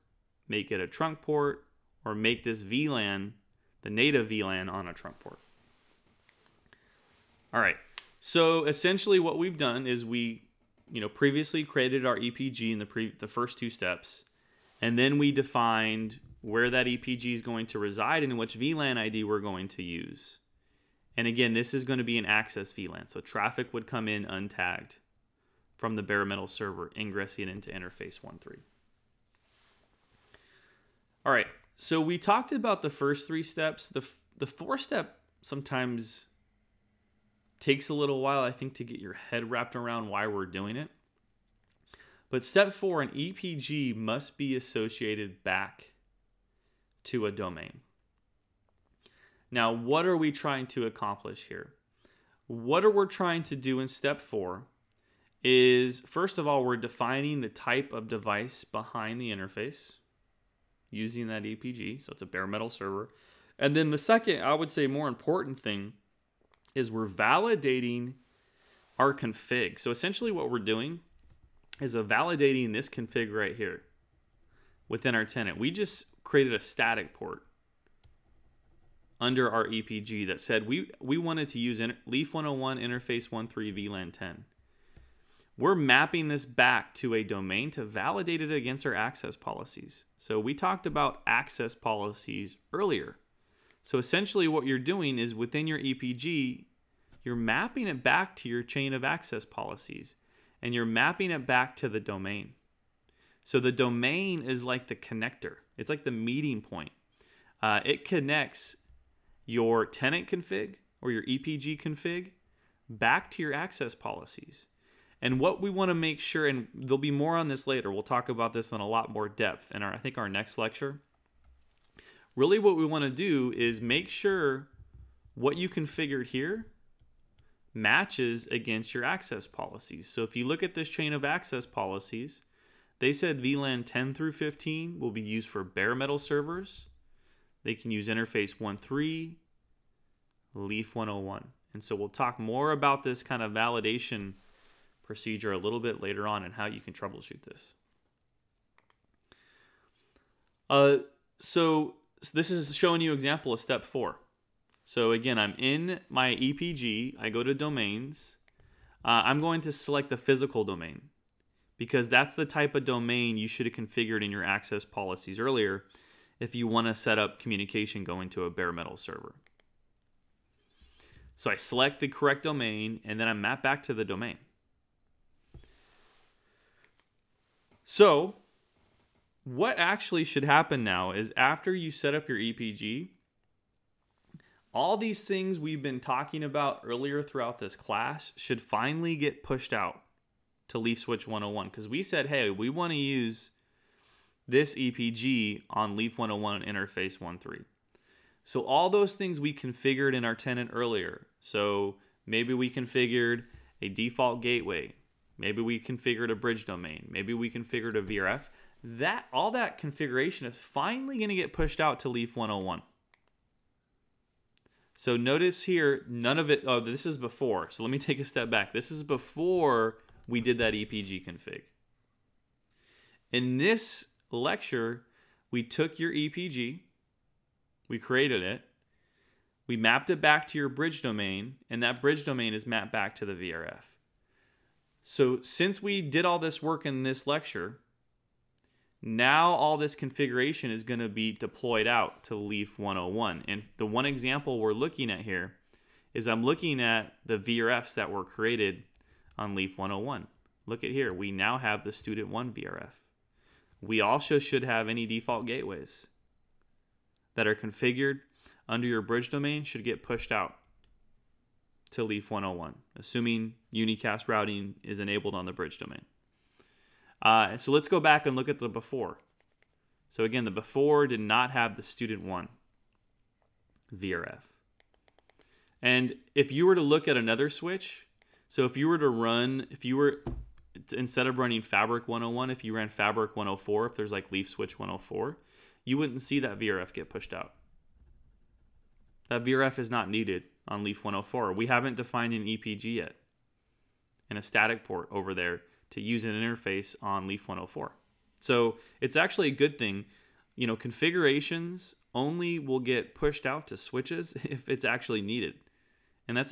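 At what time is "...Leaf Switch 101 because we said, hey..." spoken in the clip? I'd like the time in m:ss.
3:10.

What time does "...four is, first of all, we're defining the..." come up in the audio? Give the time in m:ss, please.
0:54.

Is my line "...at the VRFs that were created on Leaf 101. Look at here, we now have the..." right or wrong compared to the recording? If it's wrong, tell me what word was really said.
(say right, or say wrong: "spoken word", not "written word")
right.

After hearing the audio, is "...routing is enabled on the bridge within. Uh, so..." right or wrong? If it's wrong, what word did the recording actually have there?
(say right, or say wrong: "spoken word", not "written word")
wrong: "domain", not "within".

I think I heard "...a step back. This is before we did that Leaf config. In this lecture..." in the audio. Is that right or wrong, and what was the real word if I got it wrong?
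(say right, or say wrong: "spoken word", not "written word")
wrong: "EPG", not "Leaf".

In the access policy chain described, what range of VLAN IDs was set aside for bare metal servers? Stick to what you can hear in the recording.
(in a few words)
10 through 15.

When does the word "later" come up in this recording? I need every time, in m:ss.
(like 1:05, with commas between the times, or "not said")
1:57, 2:26.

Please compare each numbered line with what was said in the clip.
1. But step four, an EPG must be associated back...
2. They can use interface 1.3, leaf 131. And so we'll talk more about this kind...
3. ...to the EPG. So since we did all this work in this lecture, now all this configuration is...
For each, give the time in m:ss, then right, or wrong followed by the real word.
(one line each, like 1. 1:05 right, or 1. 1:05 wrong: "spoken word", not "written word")
1. 0:42 right
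2. 2:17 wrong: "101", not "131"
3. 3:53 wrong: "VRF", not "EPG".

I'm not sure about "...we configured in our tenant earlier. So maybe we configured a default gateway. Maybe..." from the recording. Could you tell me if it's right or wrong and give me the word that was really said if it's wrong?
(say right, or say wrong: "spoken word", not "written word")
right.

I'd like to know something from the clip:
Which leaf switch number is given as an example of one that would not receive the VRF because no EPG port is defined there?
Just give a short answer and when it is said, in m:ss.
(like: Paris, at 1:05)
104, at 4:44.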